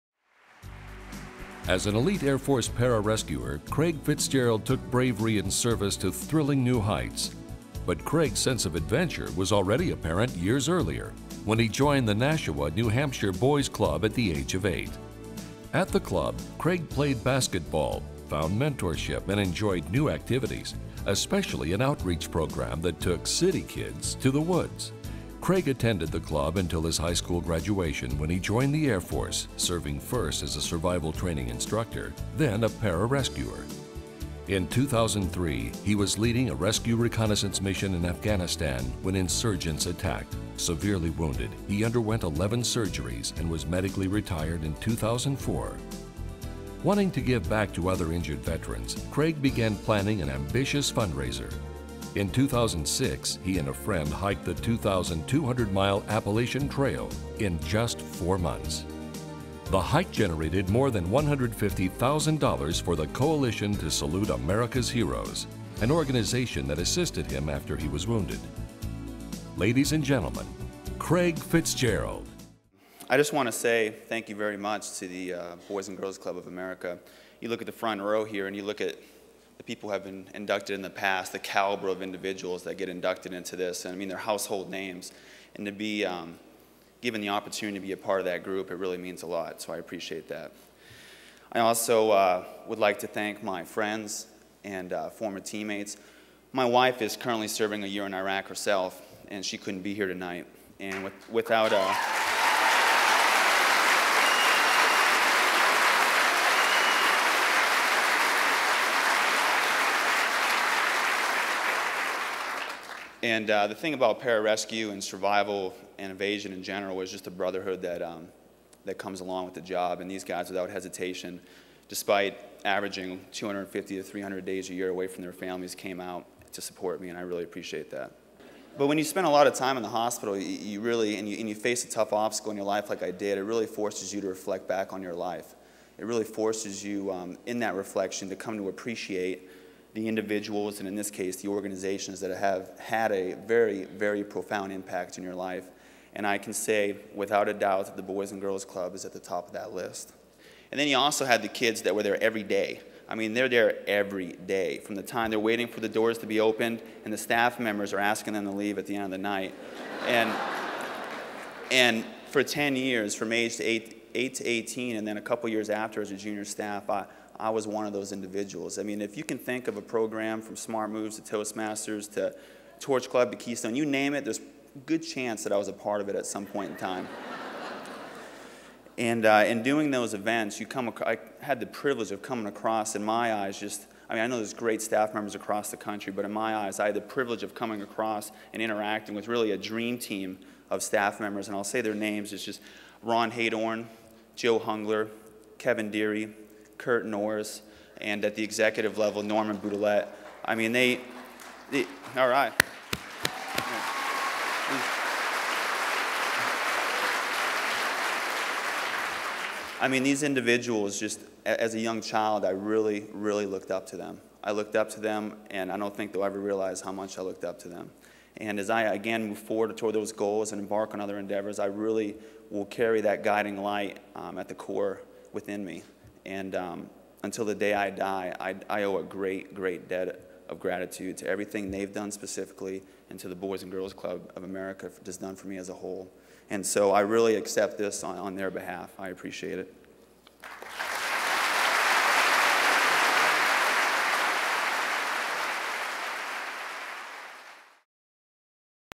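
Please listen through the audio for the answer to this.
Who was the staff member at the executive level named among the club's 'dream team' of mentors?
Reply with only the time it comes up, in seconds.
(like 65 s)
199 s.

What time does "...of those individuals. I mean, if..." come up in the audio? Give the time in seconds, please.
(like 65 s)
167 s.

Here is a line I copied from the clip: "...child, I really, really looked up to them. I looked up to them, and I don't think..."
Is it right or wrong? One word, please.
right.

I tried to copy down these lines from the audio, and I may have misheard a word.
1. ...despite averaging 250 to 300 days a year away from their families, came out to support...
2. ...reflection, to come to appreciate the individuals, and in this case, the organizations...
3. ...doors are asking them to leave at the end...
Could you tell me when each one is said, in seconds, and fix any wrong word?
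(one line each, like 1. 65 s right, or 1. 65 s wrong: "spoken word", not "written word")
1. 121 s right
2. 137 s right
3. 157 s wrong: "members", not "doors".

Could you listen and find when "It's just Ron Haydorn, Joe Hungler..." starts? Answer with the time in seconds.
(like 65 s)
192 s.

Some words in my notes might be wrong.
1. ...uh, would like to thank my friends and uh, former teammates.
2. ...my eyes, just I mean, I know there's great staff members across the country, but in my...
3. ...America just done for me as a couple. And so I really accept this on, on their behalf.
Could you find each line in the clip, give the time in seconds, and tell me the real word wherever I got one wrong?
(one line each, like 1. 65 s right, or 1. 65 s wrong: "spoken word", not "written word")
1. 92 s right
2. 183 s right
3. 234 s wrong: "whole", not "couple".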